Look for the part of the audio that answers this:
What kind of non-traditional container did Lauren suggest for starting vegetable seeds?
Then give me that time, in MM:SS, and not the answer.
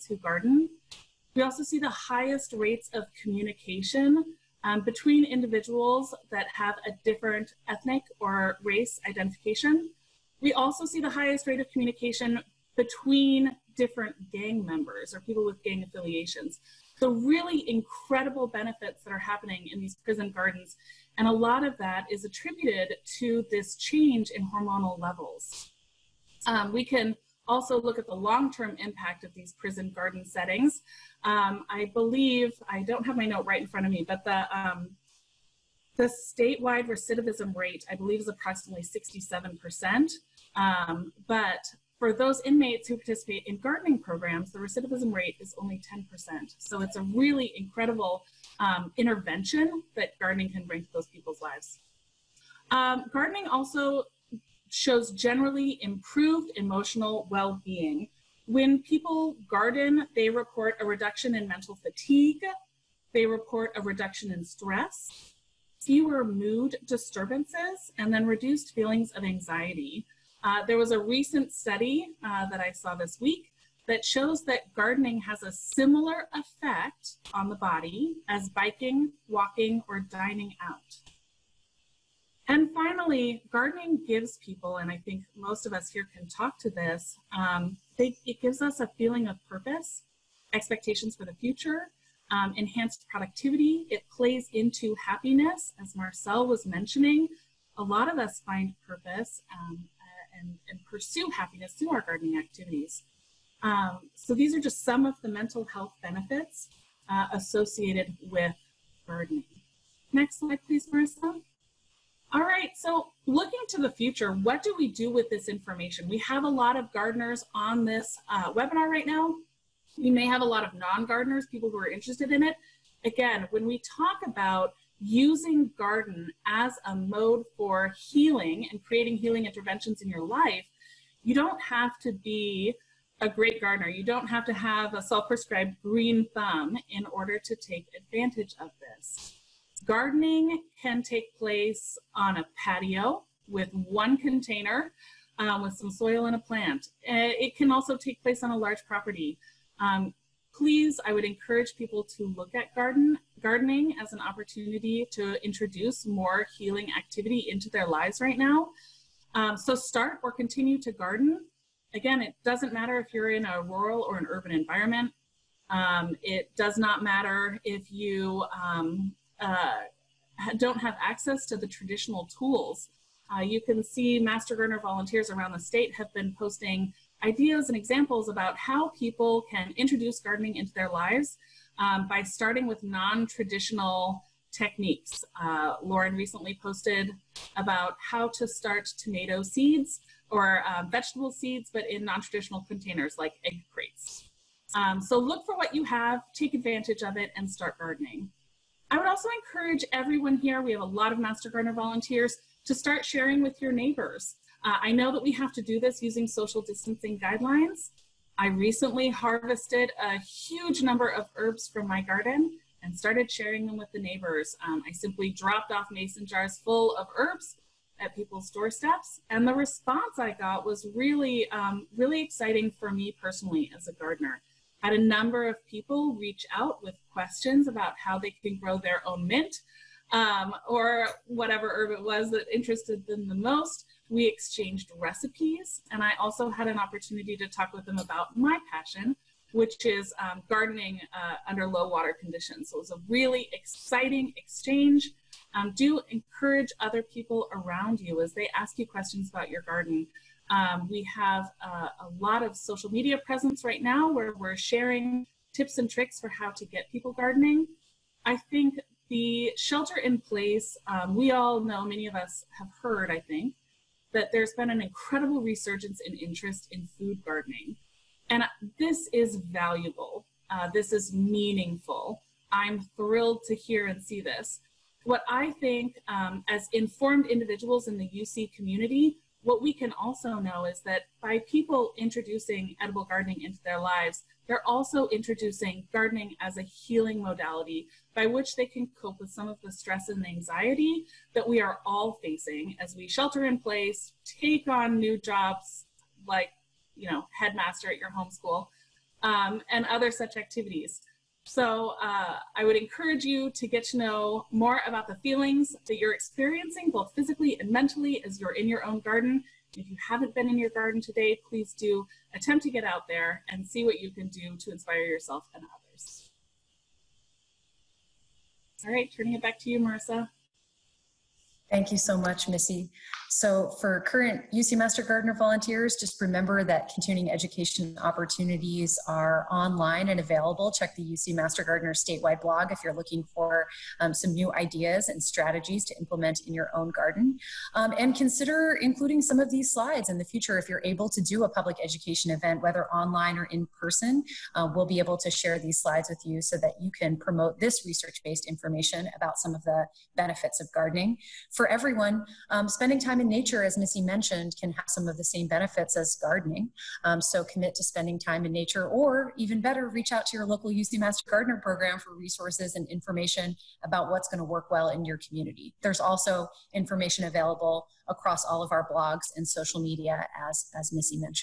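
03:13.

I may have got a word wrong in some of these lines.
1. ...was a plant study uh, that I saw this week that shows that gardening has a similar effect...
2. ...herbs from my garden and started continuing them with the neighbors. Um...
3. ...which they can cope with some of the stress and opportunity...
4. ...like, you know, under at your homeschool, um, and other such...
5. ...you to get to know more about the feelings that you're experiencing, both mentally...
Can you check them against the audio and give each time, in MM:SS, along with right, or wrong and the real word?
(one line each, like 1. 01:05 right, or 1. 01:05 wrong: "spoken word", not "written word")
1. 01:10 wrong: "recent", not "plant"
2. 03:31 wrong: "sharing", not "continuing"
3. 04:48 wrong: "anxiety", not "opportunity"
4. 04:56 wrong: "headmaster", not "under"
5. 05:03 wrong: "physically", not "mentally".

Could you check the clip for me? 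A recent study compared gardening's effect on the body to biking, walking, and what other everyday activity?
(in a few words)
Dining out.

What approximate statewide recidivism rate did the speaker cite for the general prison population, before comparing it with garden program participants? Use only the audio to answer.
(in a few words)
67%.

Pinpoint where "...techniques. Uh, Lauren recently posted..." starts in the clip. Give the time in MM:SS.
03:04.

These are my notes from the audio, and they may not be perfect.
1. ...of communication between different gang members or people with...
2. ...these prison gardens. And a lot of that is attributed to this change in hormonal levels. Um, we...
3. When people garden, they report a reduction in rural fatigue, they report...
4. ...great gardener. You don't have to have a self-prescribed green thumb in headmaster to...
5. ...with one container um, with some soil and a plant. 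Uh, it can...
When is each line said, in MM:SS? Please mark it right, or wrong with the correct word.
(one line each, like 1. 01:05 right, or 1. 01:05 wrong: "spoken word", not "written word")
1. 00:11 right
2. 00:19 right
3. 00:58 wrong: "mental", not "rural"
4. 02:13 wrong: "order", not "headmaster"
5. 02:23 right.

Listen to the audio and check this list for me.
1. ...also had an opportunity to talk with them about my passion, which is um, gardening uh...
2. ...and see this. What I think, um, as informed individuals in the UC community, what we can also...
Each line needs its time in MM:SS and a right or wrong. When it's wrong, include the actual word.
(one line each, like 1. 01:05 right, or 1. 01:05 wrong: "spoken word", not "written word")
1. 03:56 right
2. 04:33 right.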